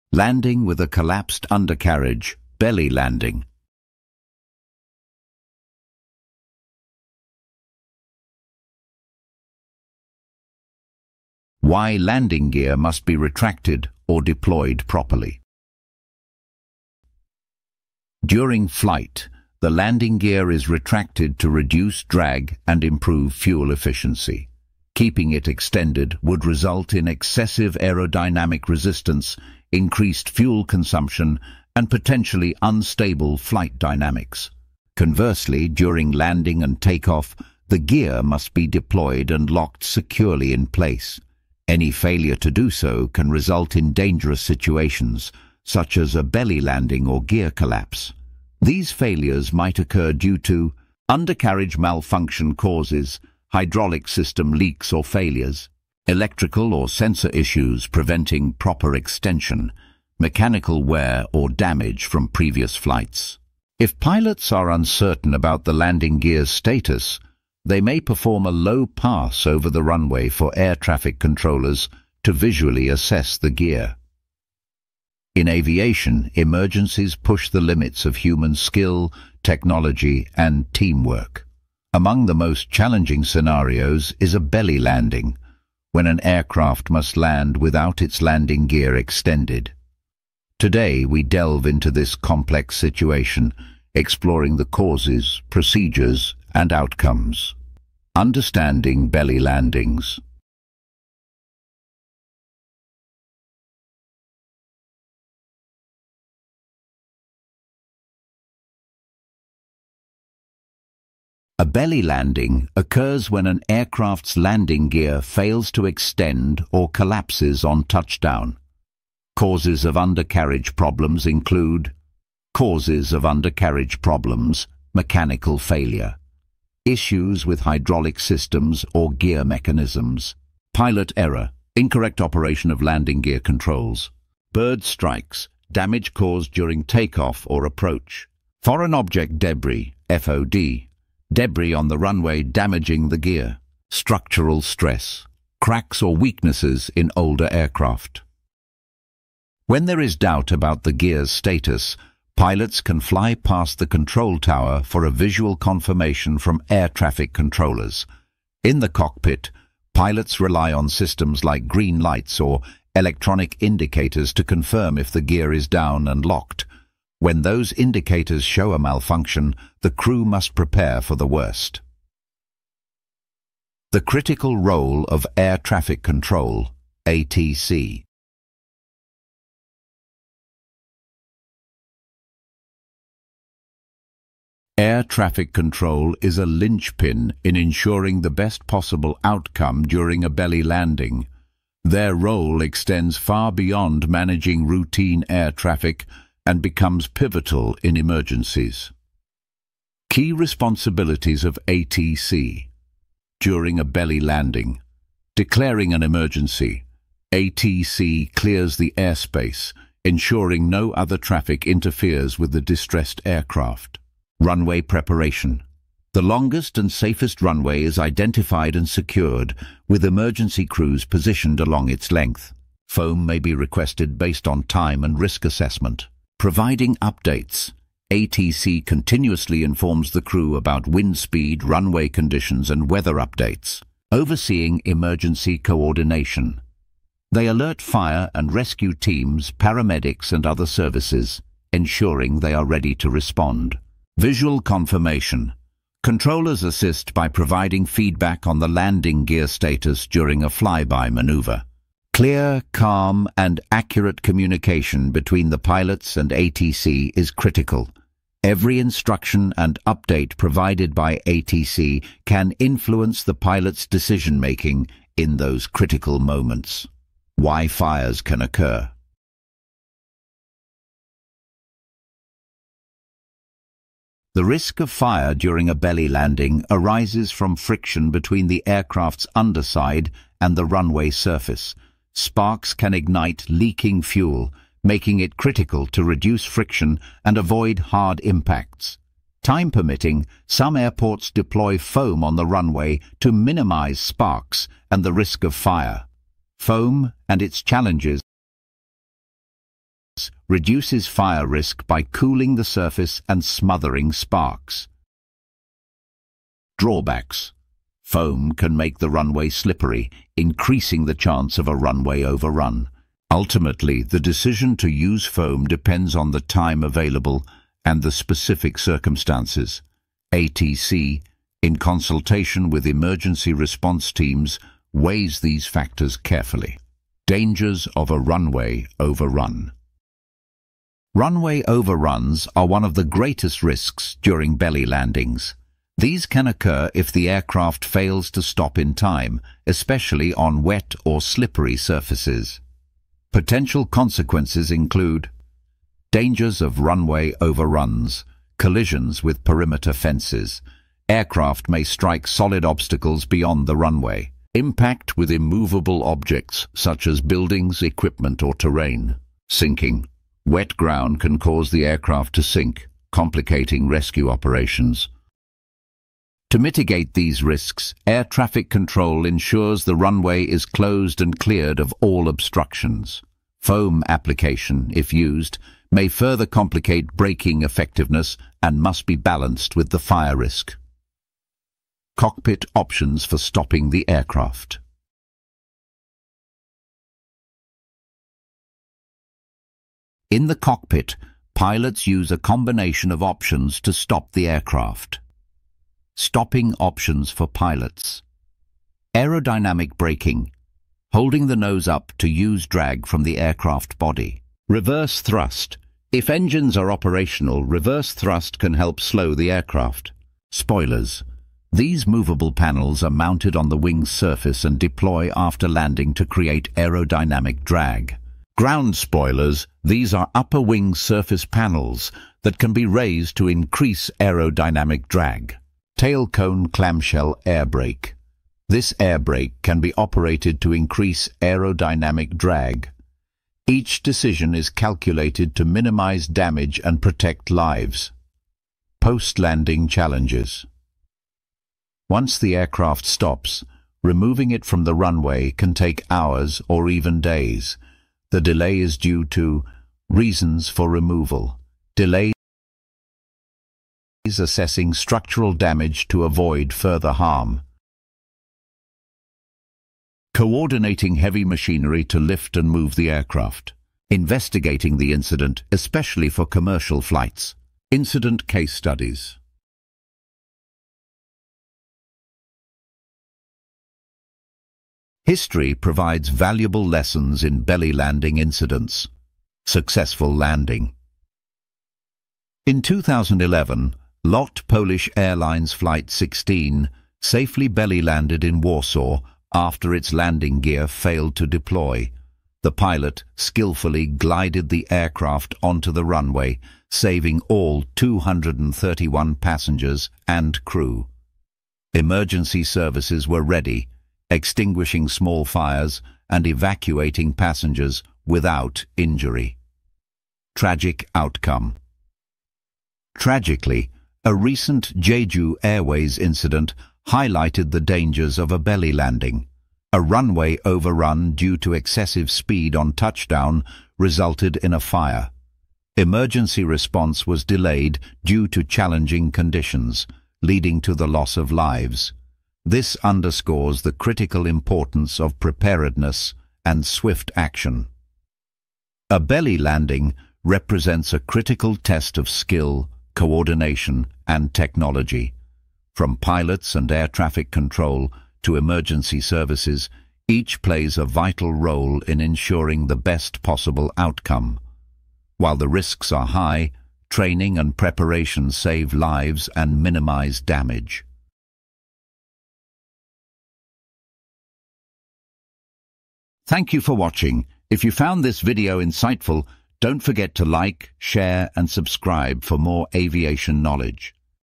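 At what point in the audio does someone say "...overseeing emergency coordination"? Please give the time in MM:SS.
03:54.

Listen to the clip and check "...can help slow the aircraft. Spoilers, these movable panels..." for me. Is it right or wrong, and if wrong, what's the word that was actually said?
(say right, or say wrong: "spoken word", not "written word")
right.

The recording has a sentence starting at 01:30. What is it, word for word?
Today we delve into this complex situation, exploring the causes, procedures and outcomes.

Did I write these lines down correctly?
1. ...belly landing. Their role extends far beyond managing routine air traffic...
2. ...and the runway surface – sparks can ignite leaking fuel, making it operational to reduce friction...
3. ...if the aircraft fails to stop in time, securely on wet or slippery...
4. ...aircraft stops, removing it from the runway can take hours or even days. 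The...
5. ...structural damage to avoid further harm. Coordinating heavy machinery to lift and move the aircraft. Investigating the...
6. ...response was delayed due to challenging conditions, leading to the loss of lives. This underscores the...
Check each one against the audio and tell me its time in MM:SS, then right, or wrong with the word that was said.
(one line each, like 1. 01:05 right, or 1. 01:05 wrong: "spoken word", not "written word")
1. 03:10 right
2. 04:40 wrong: "critical", not "operational"
3. 05:36 wrong: "especially", not "securely"
4. 07:22 right
5. 07:34 right
6. 08:46 right.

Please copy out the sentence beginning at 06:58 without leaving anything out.
Ground spoilers, these are upper wing surface panels that can be raised to increase aerodynamic drag tail cone clamshell air brake.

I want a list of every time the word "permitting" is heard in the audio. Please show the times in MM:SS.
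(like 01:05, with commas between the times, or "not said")
04:49.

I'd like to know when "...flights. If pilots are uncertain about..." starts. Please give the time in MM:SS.
01:02.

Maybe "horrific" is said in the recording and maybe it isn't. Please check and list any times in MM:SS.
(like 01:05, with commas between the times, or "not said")
not said.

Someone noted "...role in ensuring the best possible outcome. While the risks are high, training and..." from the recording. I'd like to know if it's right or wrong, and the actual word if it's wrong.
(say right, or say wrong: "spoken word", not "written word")
right.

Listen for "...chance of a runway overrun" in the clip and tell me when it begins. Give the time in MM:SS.
05:11.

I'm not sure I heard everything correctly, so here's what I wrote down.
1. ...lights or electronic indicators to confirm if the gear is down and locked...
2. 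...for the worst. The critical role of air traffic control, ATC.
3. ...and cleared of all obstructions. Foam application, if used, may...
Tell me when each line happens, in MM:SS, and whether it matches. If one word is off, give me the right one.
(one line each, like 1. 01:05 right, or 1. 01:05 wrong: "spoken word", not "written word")
1. 02:42 right
2. 02:51 right
3. 06:11 right.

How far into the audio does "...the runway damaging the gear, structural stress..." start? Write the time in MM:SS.
02:21.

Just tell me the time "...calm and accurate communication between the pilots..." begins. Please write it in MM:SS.
04:12.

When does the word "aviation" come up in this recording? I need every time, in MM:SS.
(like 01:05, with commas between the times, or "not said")
01:15, 09:32.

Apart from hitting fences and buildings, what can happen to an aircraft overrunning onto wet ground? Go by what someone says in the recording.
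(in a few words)
Sinking.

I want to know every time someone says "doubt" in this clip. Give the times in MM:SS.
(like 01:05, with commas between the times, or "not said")
02:30.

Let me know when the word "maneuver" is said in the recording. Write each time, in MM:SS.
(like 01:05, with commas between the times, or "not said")
04:11.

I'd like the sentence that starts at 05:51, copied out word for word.
Aircraft may strike solid obstacles beyond the runway.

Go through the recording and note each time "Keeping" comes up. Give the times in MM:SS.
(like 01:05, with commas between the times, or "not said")
00:24.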